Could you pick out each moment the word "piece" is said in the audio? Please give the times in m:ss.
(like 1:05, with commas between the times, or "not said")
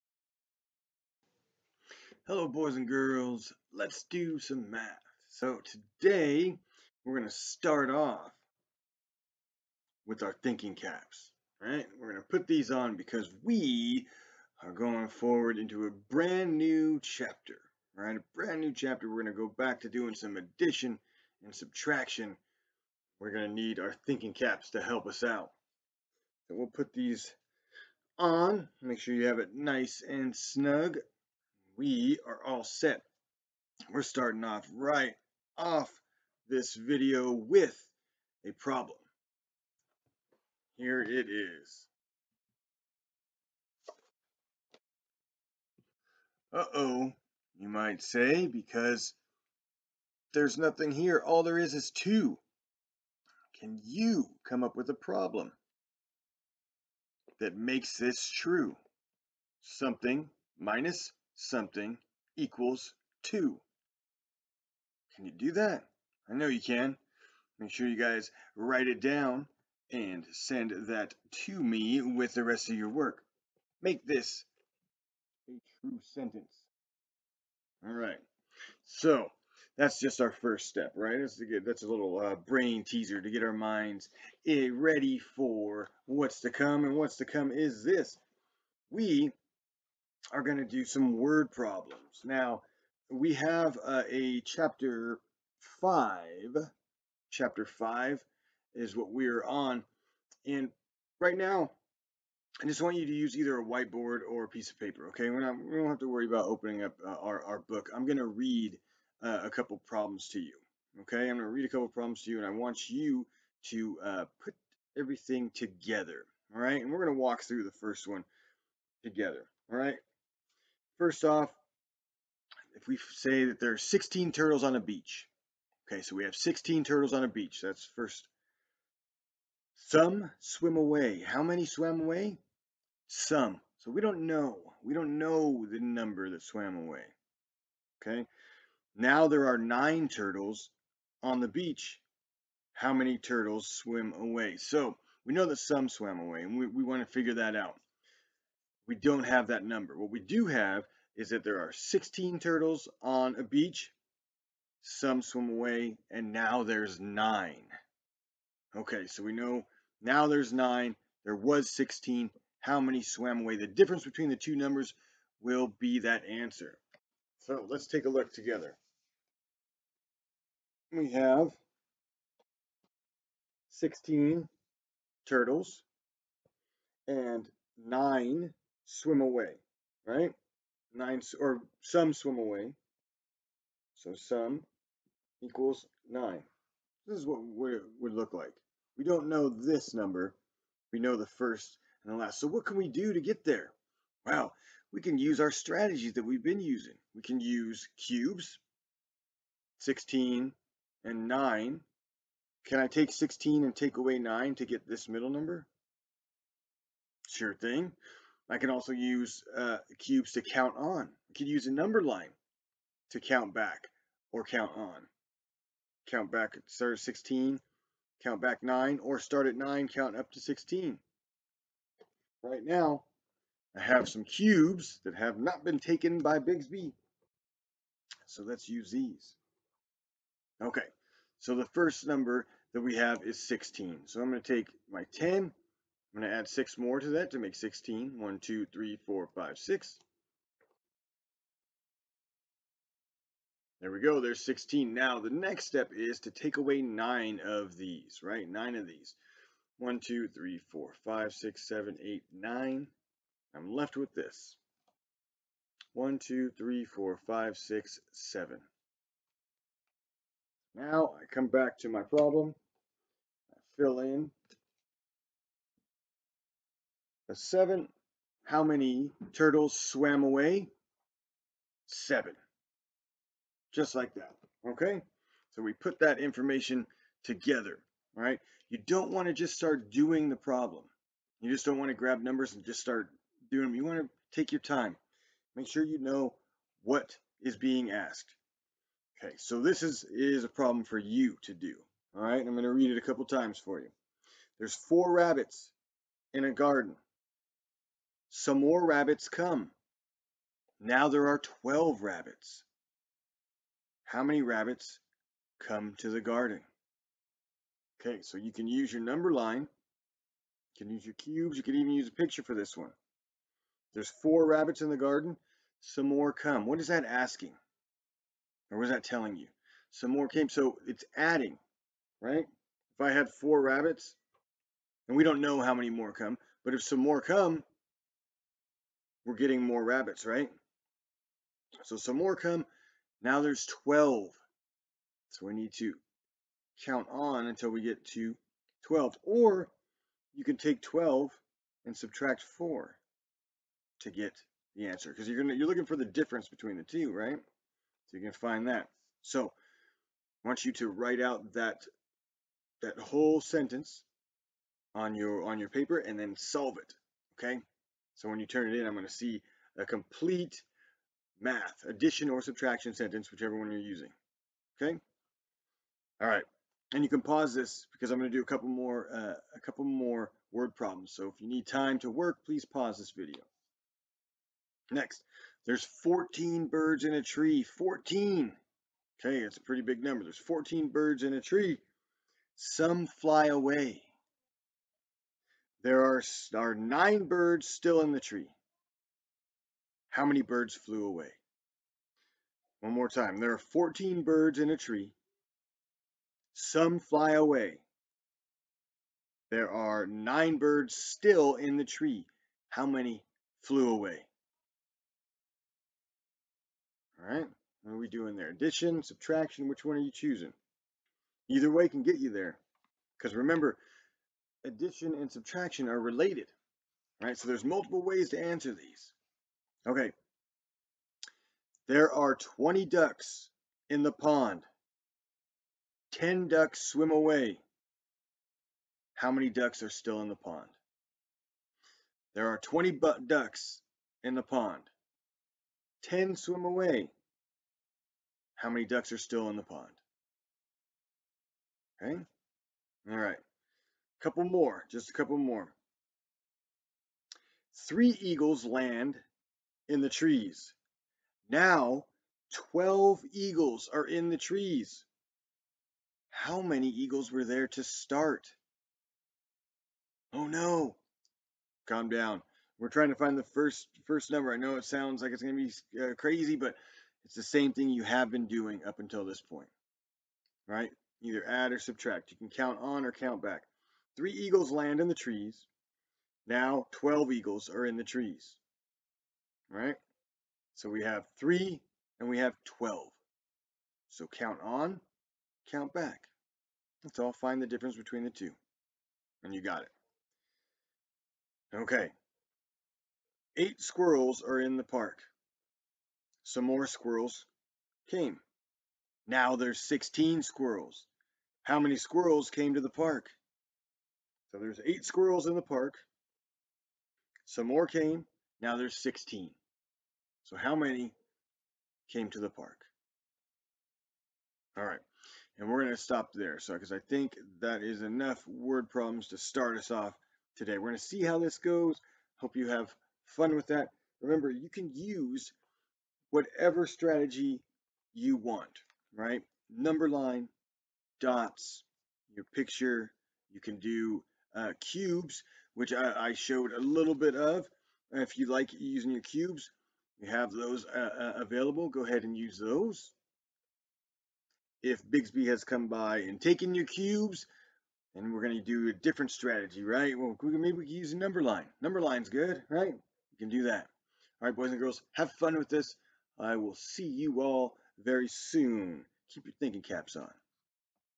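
1:44.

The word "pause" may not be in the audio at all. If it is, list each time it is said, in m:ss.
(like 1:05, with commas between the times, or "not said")
6:07, 6:12.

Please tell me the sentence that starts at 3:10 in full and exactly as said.
We know the first and the last.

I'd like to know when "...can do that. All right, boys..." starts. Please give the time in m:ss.
9:13.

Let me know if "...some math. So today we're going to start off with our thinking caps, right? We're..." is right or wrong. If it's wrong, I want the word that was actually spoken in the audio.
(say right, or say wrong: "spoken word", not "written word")
right.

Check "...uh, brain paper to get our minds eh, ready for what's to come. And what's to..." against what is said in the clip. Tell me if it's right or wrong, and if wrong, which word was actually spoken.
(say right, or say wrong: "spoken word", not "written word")
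wrong: "teaser", not "paper".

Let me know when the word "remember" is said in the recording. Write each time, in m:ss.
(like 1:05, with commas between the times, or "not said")
6:53, 8:44.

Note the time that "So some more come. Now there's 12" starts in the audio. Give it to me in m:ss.
5:31.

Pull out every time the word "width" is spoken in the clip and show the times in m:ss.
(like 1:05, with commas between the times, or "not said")
not said.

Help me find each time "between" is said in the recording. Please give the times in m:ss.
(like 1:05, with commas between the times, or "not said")
2:44, 5:46, 8:07.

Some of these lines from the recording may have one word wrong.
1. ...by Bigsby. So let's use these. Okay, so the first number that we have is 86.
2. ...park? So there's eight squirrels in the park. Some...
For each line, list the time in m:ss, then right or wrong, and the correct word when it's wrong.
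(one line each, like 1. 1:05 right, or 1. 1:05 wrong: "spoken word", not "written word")
1. 3:46 wrong: "16", not "86"
2. 8:22 right.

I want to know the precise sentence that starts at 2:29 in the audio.
What we do have is that there are 16 turtles on a beach.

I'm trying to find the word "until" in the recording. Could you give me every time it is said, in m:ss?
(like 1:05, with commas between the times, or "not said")
5:37, 7:48.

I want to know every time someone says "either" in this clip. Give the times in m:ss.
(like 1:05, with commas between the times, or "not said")
1:43, 6:51, 7:51.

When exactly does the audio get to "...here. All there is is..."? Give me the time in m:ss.
0:50.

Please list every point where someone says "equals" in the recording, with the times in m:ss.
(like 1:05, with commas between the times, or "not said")
1:02, 3:05.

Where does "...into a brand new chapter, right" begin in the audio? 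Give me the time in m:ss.
0:15.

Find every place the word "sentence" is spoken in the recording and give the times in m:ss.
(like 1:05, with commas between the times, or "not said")
1:16, 5:53, 6:02.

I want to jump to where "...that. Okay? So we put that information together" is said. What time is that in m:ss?
4:34.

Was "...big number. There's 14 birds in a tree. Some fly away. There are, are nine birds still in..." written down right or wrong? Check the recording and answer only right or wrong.
right.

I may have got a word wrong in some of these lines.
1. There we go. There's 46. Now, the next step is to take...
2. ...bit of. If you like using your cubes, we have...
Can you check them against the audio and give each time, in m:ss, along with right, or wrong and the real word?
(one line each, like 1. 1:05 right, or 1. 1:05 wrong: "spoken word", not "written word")
1. 4:03 wrong: "16", not "46"
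2. 8:57 right.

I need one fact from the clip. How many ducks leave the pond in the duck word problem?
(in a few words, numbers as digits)
10.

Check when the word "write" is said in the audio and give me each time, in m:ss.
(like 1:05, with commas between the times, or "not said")
1:08, 5:50.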